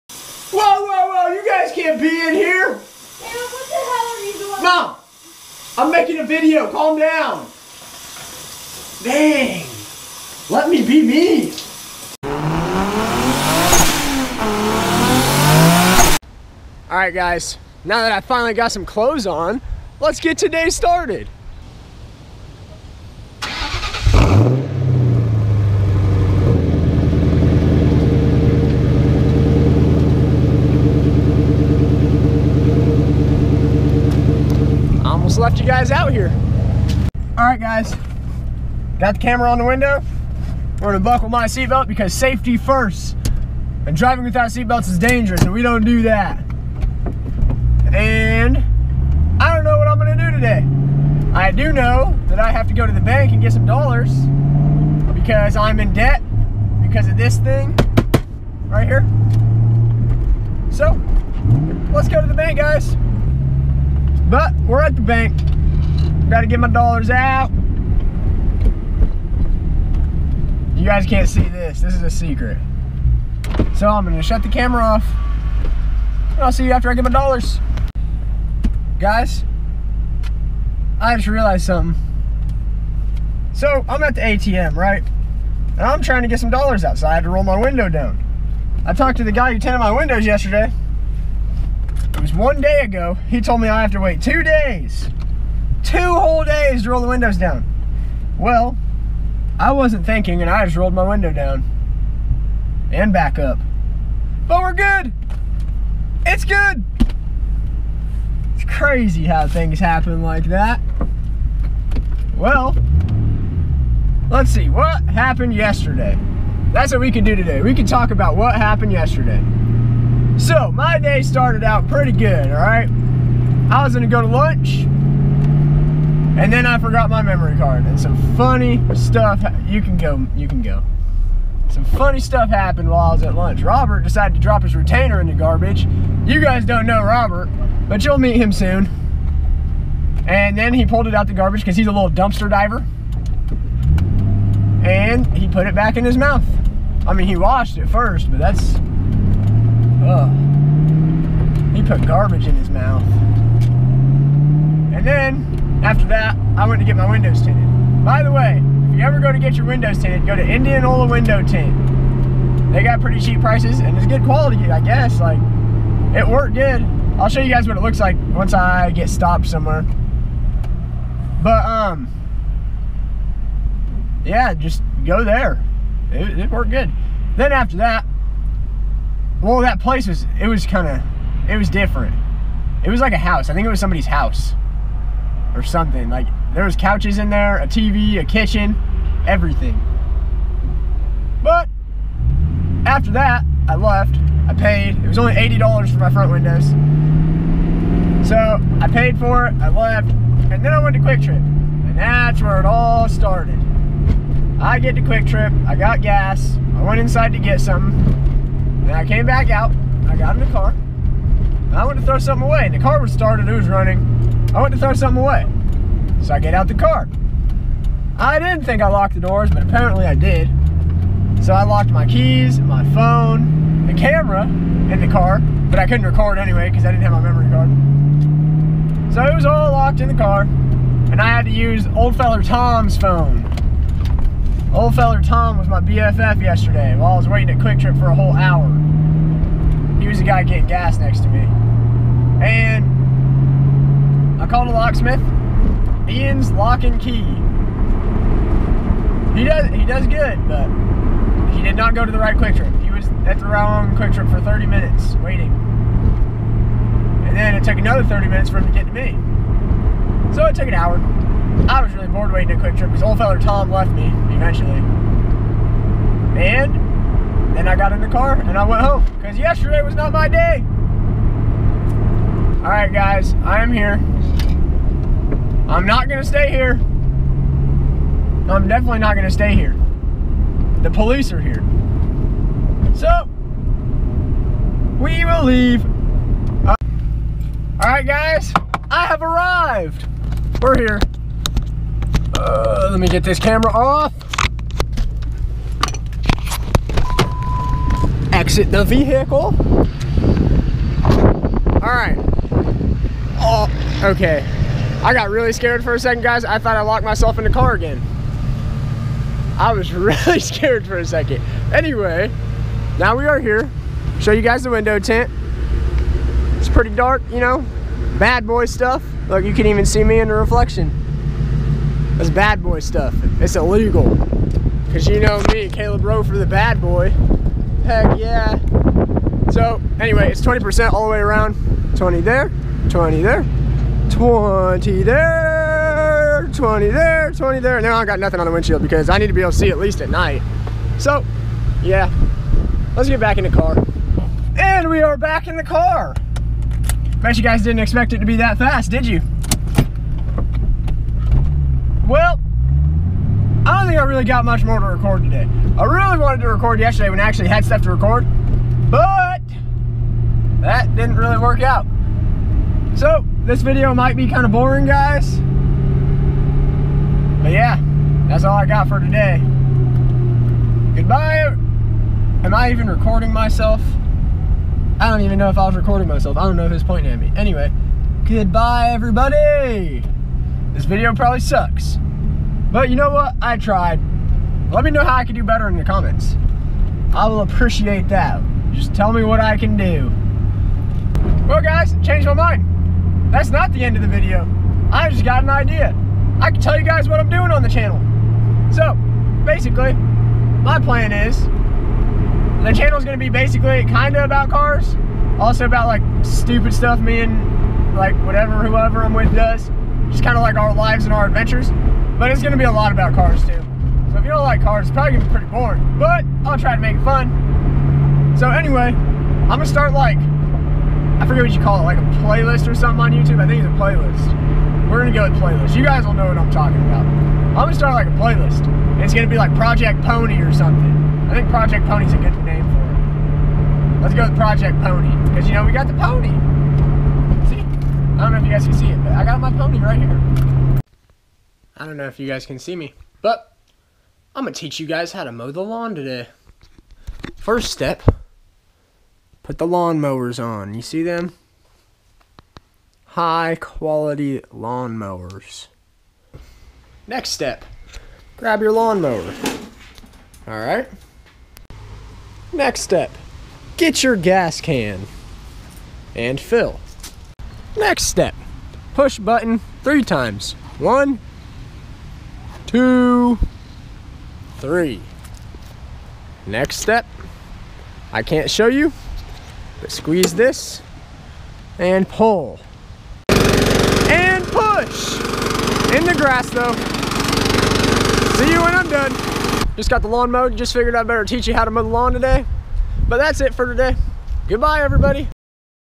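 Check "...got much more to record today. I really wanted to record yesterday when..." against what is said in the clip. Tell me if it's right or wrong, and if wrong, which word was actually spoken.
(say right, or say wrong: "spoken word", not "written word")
right.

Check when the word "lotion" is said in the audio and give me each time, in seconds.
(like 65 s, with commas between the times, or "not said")
not said.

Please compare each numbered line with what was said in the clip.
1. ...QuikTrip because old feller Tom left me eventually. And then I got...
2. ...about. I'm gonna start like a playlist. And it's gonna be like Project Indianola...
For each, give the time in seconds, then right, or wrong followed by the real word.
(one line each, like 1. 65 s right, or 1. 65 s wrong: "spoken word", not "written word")
1. 262 s right
2. 426 s wrong: "Pony", not "Indianola".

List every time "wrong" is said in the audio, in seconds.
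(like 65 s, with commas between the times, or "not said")
253 s.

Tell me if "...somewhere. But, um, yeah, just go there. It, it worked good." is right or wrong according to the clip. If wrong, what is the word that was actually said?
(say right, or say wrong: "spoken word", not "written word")
right.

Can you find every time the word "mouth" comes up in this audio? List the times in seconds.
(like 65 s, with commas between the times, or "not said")
146 s, 152 s.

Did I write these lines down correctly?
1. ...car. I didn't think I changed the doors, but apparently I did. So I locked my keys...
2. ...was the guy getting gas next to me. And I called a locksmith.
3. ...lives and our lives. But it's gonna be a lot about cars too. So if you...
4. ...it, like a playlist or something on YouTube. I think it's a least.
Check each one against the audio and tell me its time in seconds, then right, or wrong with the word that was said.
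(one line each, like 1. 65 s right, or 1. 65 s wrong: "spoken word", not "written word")
1. 216 s wrong: "locked", not "changed"
2. 240 s right
3. 410 s wrong: "adventures", not "lives"
4. 421 s wrong: "playlist", not "least".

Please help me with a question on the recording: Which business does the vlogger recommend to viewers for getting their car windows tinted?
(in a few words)
Indianola Window Tint.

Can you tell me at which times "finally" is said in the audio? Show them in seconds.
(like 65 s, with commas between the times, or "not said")
18 s.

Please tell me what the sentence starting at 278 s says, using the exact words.
I'm definitely not gonna stay here.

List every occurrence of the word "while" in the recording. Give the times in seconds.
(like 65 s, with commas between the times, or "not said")
132 s, 236 s.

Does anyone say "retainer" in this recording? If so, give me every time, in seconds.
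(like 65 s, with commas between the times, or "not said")
134 s.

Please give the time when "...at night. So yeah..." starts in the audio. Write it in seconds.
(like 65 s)
340 s.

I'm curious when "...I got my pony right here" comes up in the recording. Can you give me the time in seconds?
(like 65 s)
439 s.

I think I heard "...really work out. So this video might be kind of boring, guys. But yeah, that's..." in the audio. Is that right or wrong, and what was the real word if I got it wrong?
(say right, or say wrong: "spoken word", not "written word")
right.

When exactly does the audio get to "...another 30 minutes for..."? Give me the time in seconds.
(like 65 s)
257 s.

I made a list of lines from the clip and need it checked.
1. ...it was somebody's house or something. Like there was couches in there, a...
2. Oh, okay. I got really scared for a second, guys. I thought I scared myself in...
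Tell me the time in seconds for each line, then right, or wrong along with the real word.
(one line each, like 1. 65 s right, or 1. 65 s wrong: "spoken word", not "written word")
1. 183 s right
2. 303 s wrong: "locked", not "scared".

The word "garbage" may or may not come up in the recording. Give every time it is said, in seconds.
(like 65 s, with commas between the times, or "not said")
135 s, 141 s, 152 s.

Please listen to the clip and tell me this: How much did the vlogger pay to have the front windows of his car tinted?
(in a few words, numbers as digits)
$80.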